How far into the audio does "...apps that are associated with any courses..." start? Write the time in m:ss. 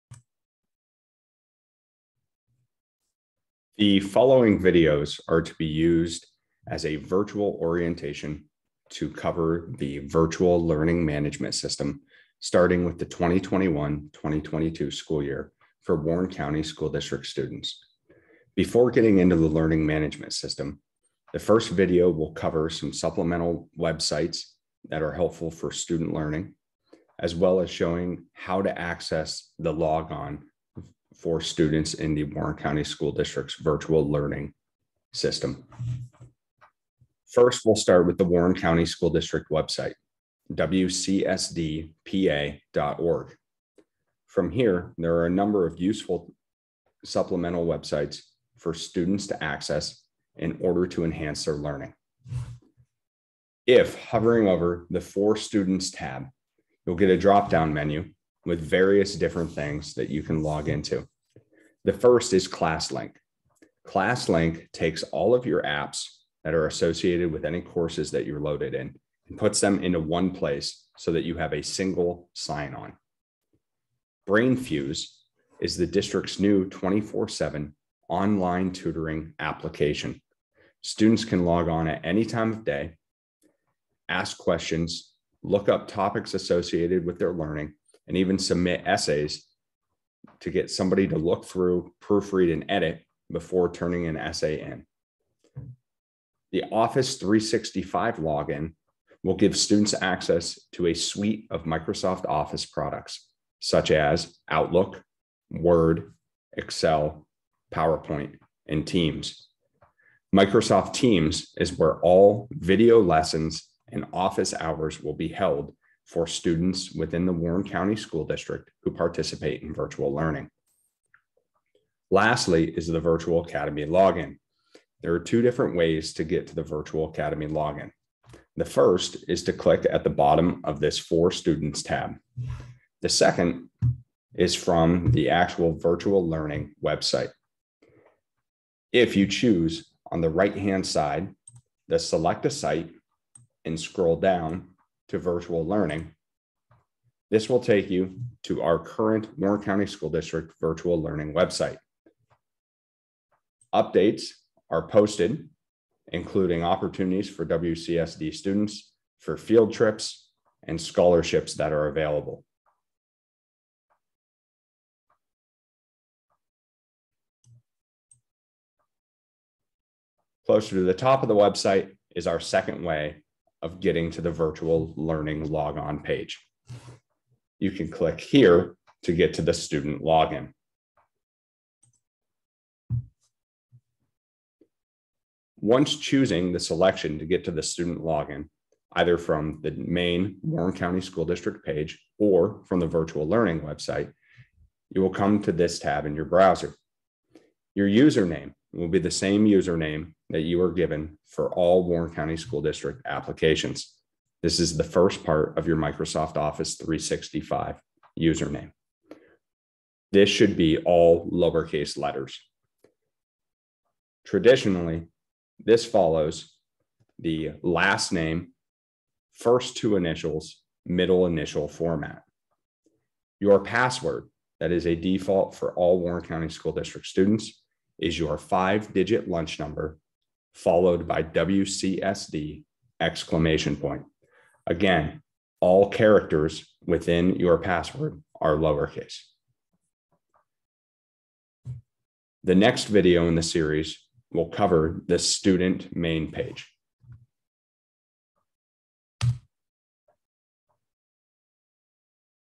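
1:05.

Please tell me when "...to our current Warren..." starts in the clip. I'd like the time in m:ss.
2:28.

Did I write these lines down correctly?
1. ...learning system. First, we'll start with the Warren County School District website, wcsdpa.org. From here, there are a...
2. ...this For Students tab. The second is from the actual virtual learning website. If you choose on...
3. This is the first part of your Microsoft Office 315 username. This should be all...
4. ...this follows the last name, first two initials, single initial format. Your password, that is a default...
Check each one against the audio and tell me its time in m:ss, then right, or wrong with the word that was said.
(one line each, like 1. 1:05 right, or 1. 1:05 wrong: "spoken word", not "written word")
1. 0:34 right
2. 2:10 right
3. 3:24 wrong: "365", not "315"
4. 3:35 wrong: "middle", not "single".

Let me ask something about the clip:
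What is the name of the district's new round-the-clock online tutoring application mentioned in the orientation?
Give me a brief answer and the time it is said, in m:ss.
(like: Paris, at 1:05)
BrainFuse, at 1:14.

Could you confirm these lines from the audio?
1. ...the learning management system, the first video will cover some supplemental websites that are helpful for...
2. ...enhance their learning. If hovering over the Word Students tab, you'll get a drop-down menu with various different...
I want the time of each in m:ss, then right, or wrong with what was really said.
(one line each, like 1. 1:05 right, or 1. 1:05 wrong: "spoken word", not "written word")
1. 0:19 right
2. 0:51 wrong: "For", not "Word".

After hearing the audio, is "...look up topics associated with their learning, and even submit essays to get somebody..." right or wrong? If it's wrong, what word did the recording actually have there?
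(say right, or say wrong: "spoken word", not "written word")
right.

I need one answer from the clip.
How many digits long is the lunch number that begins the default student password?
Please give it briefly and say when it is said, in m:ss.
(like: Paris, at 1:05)
5, at 3:48.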